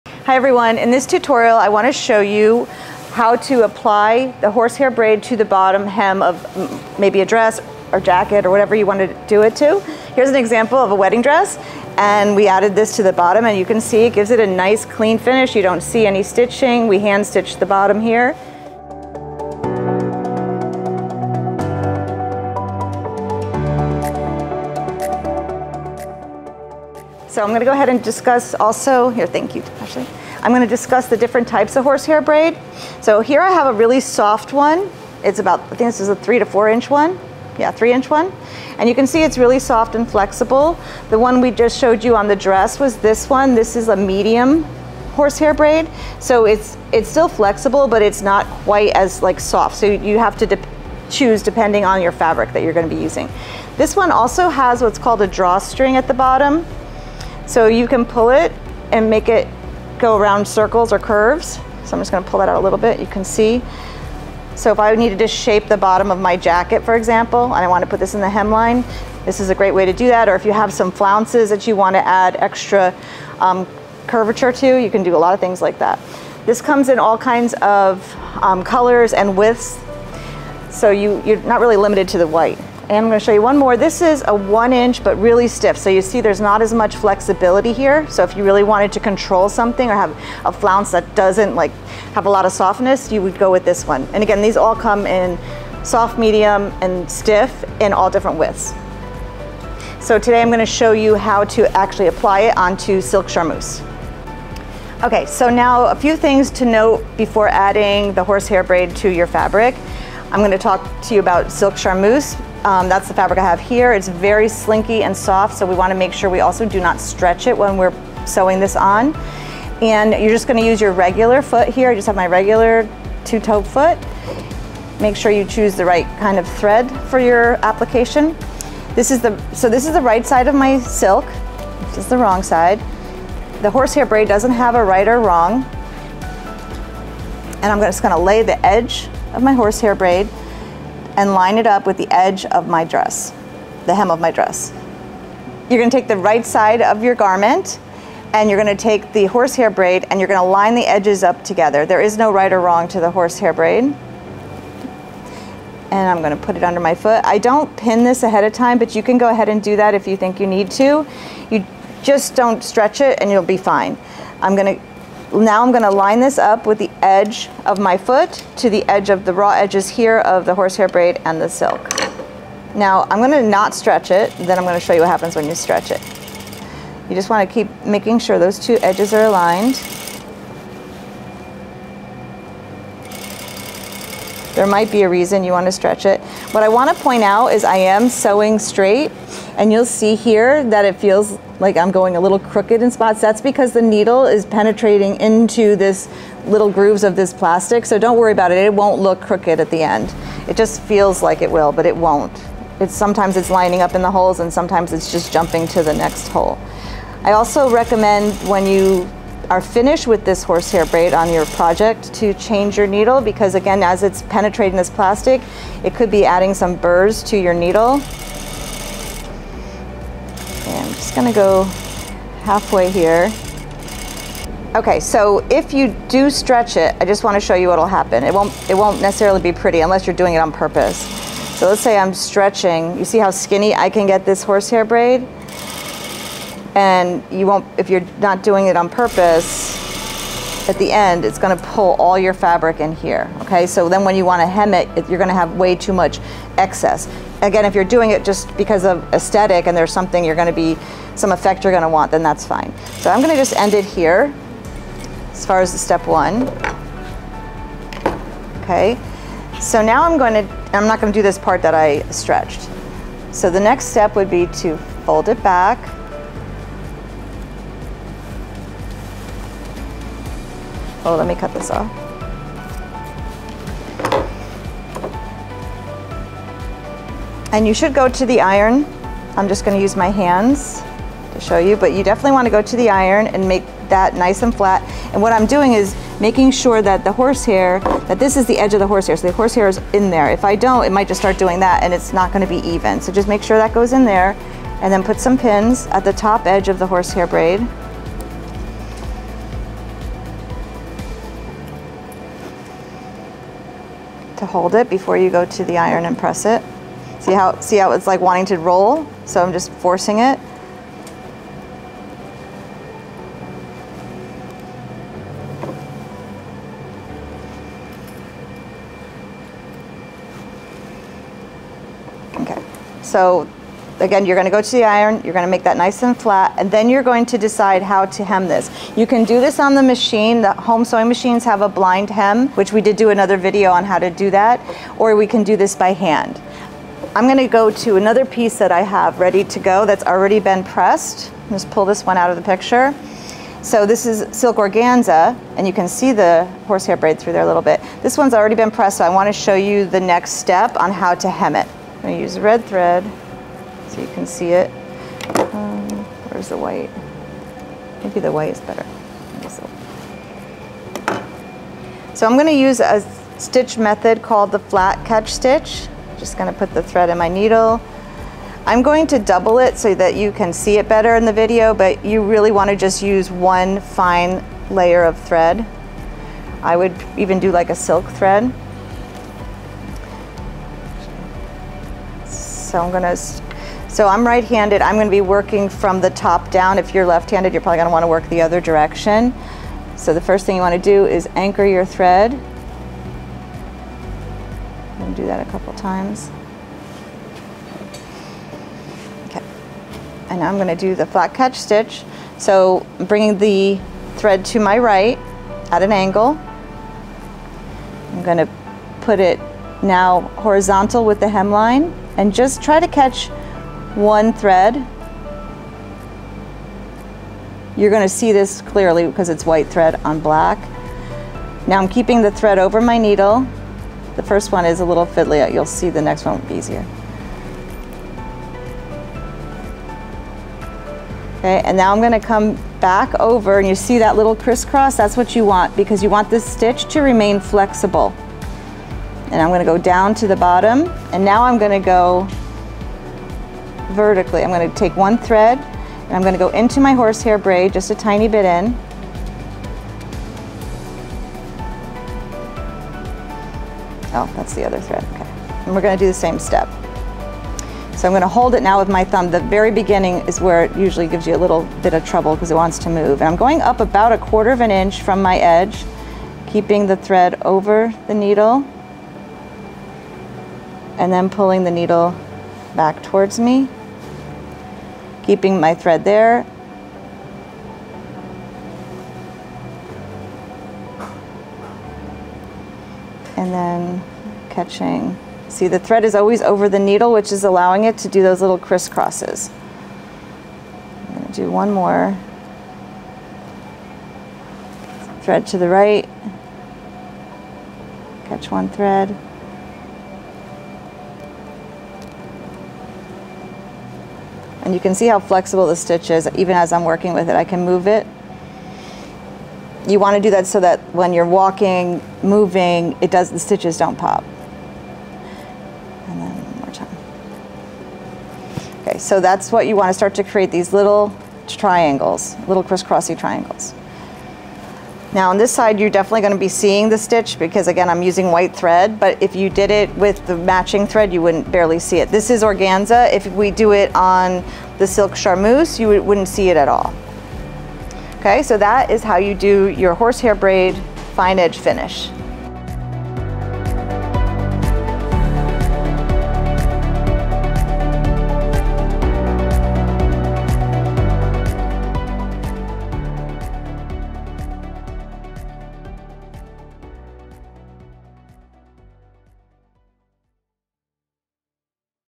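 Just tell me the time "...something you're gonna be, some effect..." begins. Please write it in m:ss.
4:09.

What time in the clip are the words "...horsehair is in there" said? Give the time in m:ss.
4:49.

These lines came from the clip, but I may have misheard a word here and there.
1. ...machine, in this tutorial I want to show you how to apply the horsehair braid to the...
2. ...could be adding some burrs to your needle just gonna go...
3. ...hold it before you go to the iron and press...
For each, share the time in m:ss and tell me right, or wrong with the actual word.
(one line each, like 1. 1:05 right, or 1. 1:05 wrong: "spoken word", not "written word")
1. 0:00 wrong: "everyone", not "machine"
2. 3:35 right
3. 5:04 right.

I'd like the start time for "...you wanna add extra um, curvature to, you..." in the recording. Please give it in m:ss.
1:11.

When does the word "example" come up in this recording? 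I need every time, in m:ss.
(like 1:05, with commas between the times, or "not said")
0:10, 1:06.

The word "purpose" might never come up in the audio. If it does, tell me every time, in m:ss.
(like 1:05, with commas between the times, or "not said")
3:50, 3:58.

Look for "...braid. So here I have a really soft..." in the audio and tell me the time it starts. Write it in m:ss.
0:32.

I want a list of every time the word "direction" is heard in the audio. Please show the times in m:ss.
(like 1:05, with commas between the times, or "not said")
6:28.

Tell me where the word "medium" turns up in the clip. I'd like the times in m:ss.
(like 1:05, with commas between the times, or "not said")
0:43, 1:36.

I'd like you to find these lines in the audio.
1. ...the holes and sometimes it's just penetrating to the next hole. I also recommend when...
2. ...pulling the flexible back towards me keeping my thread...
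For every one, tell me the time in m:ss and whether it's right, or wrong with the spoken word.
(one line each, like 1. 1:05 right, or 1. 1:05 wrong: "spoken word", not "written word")
1. 3:24 wrong: "jumping", not "penetrating"
2. 7:51 wrong: "needle", not "flexible".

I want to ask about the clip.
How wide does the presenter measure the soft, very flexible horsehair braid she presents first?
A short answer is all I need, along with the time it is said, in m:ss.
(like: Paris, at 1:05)
3 inch, at 0:37.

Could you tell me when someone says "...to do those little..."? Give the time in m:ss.
8:07.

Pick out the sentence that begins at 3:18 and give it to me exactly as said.
It won't look crooked at the end.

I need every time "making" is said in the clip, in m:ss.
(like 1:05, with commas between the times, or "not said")
2:57, 4:46.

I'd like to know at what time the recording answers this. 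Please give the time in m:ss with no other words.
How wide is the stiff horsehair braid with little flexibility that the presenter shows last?
1:24.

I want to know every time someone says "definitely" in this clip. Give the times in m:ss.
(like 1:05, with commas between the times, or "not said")
4:42, 8:45.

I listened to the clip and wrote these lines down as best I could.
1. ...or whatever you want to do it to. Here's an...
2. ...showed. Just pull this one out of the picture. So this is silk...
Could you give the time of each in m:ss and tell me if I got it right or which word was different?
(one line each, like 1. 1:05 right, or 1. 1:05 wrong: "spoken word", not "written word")
1. 0:08 right
2. 5:40 wrong: "pressed", not "showed".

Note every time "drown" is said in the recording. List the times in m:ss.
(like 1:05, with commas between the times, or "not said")
not said.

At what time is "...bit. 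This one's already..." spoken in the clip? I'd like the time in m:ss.
5:47.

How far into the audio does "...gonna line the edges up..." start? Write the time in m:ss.
2:30.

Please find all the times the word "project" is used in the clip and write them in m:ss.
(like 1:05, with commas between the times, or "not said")
3:31.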